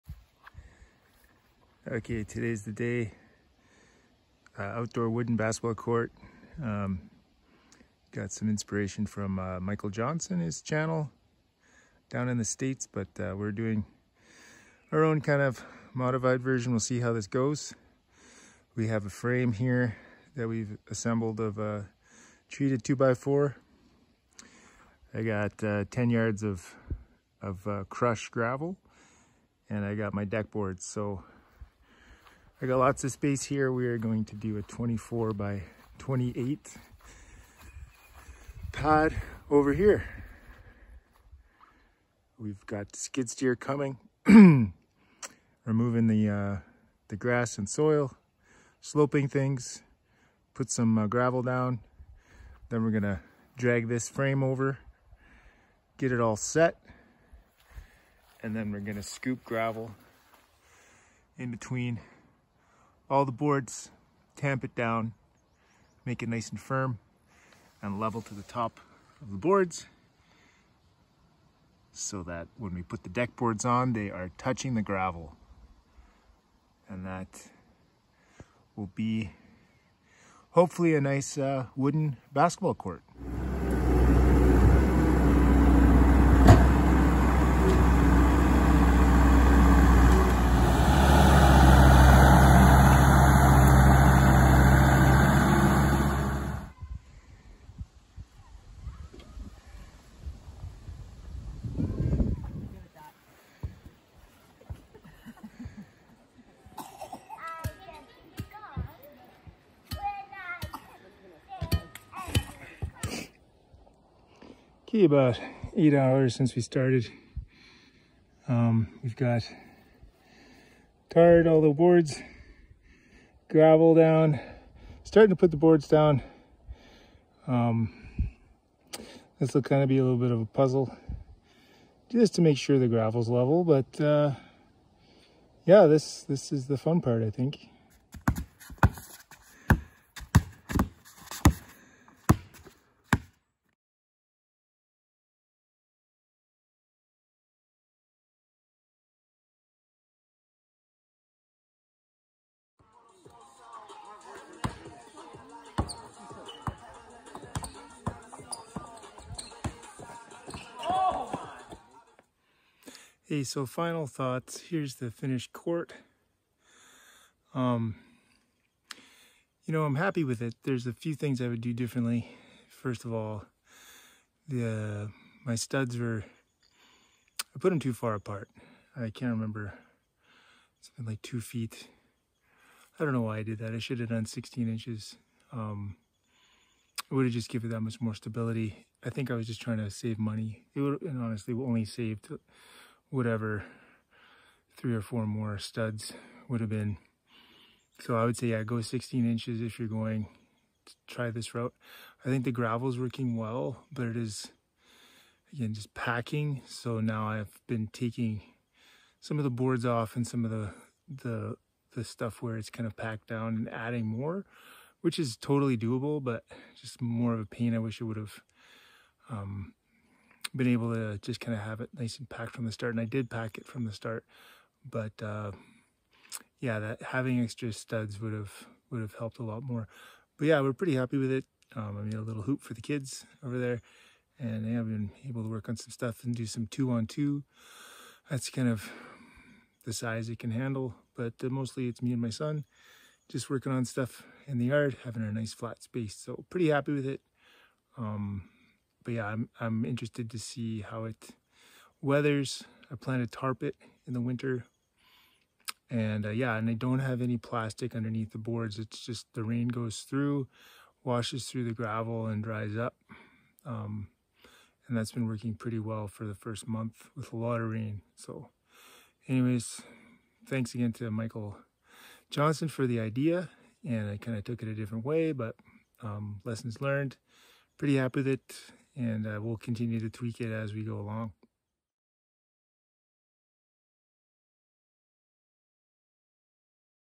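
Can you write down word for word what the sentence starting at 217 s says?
I wish it would have um, been able to just kind of have it nice and packed from the start.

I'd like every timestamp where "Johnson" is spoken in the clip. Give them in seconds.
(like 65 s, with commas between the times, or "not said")
9 s, 272 s.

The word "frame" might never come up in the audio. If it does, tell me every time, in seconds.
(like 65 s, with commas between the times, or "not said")
19 s, 54 s.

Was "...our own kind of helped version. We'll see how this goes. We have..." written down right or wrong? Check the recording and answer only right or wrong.
wrong.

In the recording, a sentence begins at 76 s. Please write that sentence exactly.
And that will be hopefully a nice uh, wooden basketball court.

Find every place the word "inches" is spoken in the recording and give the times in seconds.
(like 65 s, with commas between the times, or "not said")
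184 s, 199 s.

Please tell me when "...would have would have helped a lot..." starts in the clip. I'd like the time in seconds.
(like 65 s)
228 s.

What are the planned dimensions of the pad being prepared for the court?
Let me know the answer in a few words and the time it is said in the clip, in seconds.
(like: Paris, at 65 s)
24 by 28, at 34 s.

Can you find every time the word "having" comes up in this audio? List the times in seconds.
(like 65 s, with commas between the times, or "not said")
227 s, 245 s.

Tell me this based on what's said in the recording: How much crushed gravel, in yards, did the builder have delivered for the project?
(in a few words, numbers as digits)
10 yards.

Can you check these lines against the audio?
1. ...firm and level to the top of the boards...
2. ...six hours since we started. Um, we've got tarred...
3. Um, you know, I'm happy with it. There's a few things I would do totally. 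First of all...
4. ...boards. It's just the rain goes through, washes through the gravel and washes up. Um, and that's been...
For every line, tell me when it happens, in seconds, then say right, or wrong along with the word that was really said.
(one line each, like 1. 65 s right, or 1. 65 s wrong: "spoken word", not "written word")
1. 66 s right
2. 115 s wrong: "eight", not "six"
3. 167 s wrong: "differently", not "totally"
4. 258 s wrong: "dries", not "washes".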